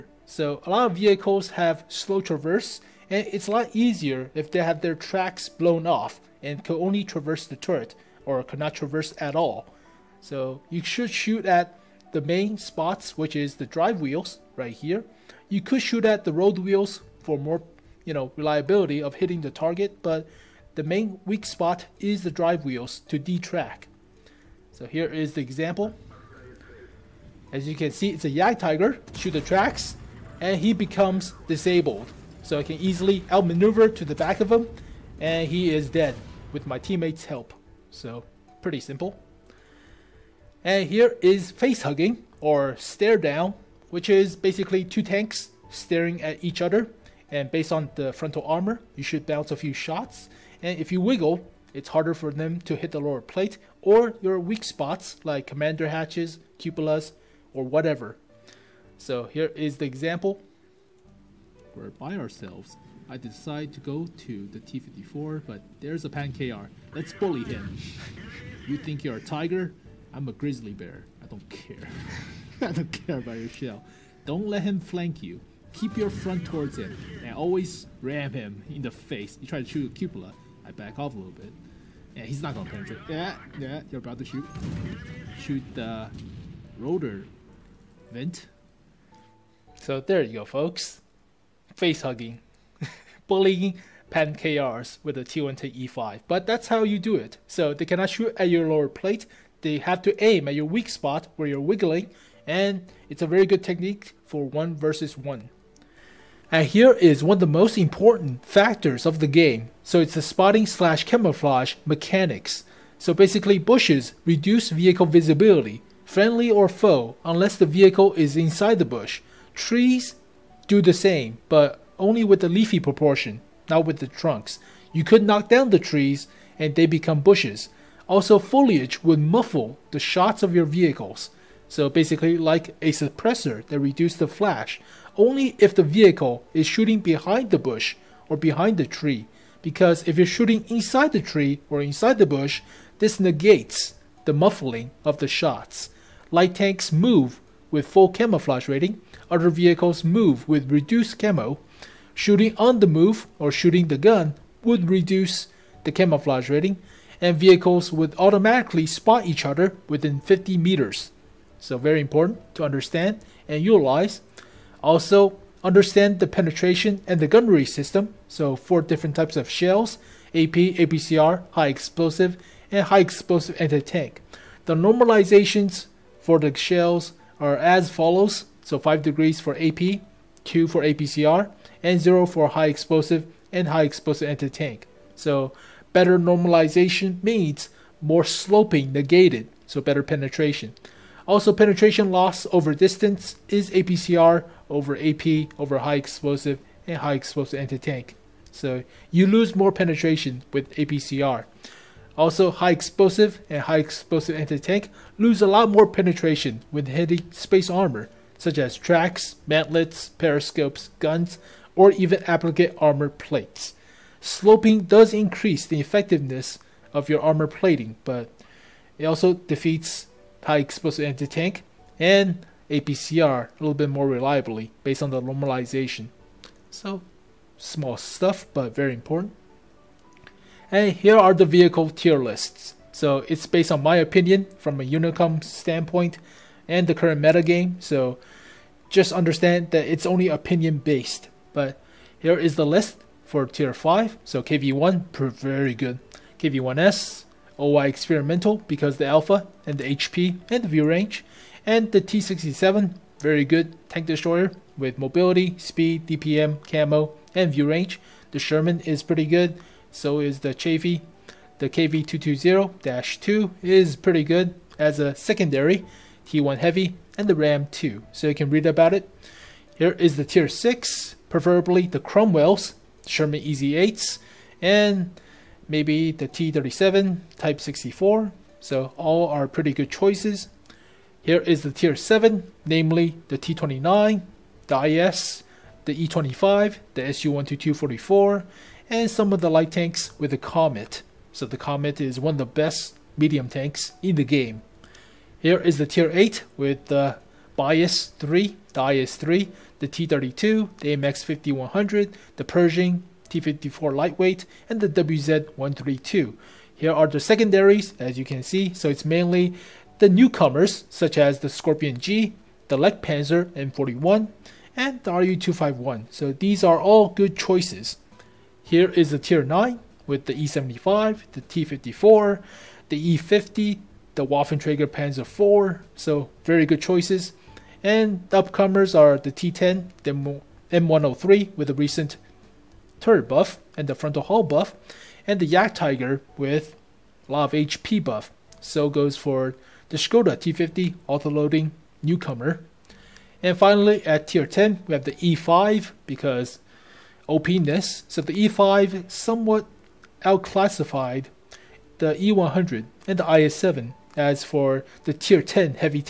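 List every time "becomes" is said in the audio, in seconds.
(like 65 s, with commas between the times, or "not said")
30 s, 126 s.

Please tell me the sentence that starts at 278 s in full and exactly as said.
So all are pretty good choices.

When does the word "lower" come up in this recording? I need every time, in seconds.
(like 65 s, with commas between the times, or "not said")
53 s, 98 s.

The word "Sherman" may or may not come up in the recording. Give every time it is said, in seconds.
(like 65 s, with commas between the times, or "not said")
258 s, 273 s.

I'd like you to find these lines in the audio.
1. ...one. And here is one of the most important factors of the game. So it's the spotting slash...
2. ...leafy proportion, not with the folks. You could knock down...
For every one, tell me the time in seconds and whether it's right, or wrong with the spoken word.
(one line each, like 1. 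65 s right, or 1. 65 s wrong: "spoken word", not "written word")
1. 105 s right
2. 122 s wrong: "trunks", not "folks".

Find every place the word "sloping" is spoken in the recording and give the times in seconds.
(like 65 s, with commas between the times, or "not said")
188 s, 214 s.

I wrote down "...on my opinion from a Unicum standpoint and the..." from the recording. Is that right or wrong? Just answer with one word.
right.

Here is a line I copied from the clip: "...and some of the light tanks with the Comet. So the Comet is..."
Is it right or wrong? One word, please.
right.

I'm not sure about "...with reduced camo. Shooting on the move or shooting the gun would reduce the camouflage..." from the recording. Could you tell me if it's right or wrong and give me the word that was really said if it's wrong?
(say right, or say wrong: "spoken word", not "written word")
right.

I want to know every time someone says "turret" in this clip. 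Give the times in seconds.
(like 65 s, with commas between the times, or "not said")
7 s, 333 s.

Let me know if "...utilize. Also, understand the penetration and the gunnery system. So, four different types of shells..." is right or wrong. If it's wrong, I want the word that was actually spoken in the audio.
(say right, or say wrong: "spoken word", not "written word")
right.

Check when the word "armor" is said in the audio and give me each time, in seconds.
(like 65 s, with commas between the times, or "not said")
48 s, 207 s, 212 s, 217 s.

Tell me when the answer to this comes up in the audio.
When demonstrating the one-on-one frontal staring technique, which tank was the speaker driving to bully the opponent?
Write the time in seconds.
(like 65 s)
95 s.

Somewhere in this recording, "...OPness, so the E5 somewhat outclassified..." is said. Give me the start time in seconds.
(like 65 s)
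347 s.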